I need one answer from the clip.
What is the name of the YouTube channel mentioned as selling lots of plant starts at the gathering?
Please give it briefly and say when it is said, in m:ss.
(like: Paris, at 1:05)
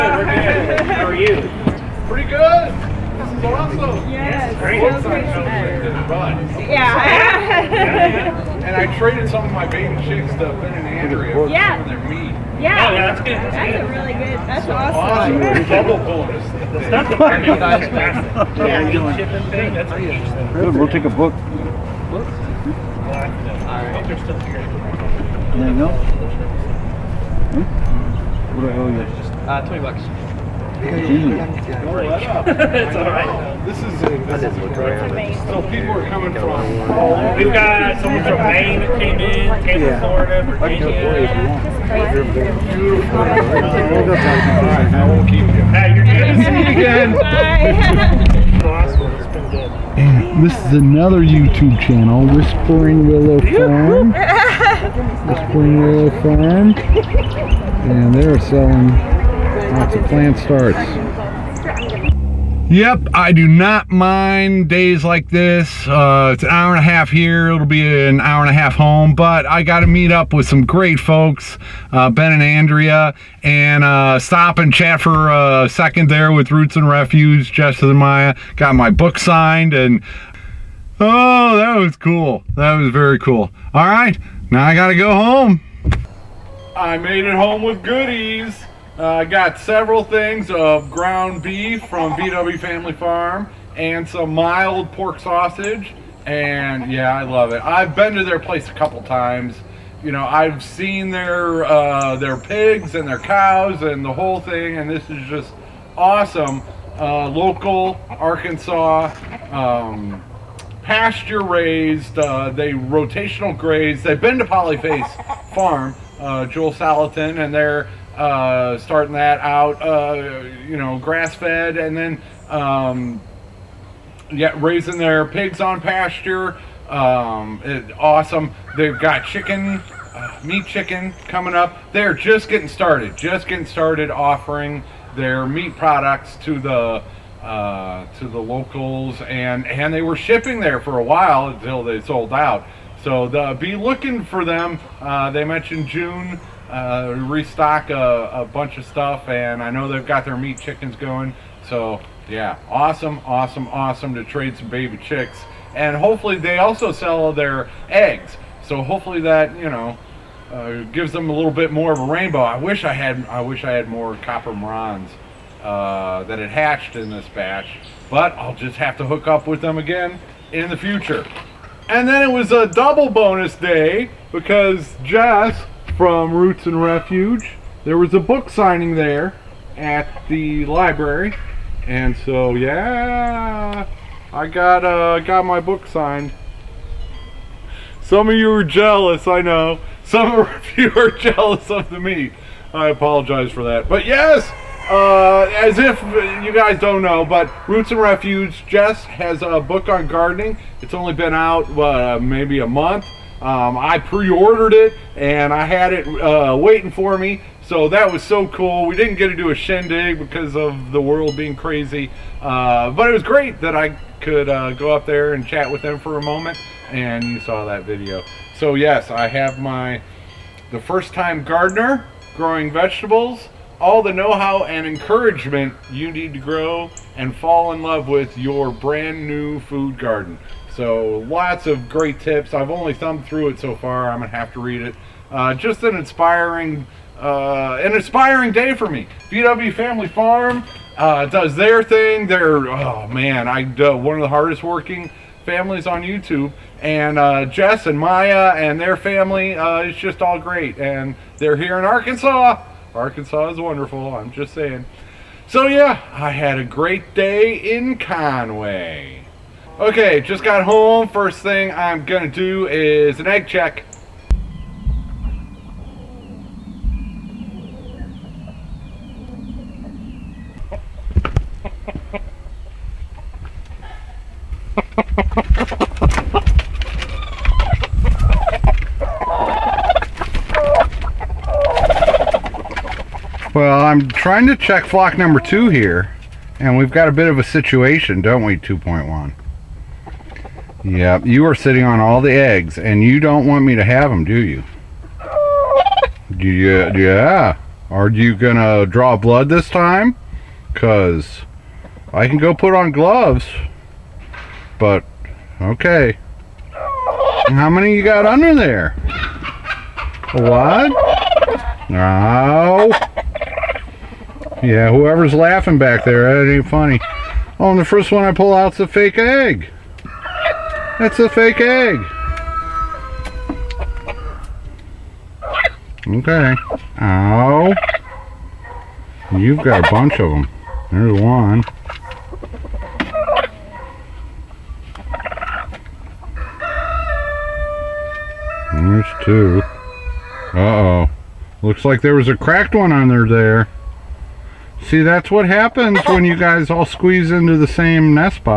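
Whispering Willow Farm, at 0:55.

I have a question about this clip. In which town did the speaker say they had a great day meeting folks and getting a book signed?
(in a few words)
Conway.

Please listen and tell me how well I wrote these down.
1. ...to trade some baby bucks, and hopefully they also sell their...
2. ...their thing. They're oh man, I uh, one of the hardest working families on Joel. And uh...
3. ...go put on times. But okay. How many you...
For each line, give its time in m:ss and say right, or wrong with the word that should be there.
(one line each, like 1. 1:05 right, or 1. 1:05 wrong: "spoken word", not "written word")
1. 2:34 wrong: "chicks", not "bucks"
2. 4:01 wrong: "YouTube", not "Joel"
3. 5:02 wrong: "gloves", not "times".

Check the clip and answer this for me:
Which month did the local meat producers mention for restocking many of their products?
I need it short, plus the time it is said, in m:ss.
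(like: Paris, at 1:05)
June, at 2:25.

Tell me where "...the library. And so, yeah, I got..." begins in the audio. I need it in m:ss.
3:00.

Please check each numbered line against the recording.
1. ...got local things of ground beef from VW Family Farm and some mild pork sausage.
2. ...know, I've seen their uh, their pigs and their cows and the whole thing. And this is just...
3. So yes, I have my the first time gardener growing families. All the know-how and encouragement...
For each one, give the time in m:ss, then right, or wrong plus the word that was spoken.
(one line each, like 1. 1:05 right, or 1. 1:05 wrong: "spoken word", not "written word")
1. 1:29 wrong: "several", not "local"
2. 1:40 right
3. 3:38 wrong: "vegetables", not "families".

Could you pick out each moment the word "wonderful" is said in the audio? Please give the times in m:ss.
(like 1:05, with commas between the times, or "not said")
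4:13.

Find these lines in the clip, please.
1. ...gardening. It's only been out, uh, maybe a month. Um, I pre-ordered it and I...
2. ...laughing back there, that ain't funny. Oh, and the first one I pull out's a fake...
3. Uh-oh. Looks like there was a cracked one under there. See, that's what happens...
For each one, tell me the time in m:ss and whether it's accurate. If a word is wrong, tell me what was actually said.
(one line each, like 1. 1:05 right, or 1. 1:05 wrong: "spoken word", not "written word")
1. 3:20 right
2. 5:15 right
3. 5:40 right.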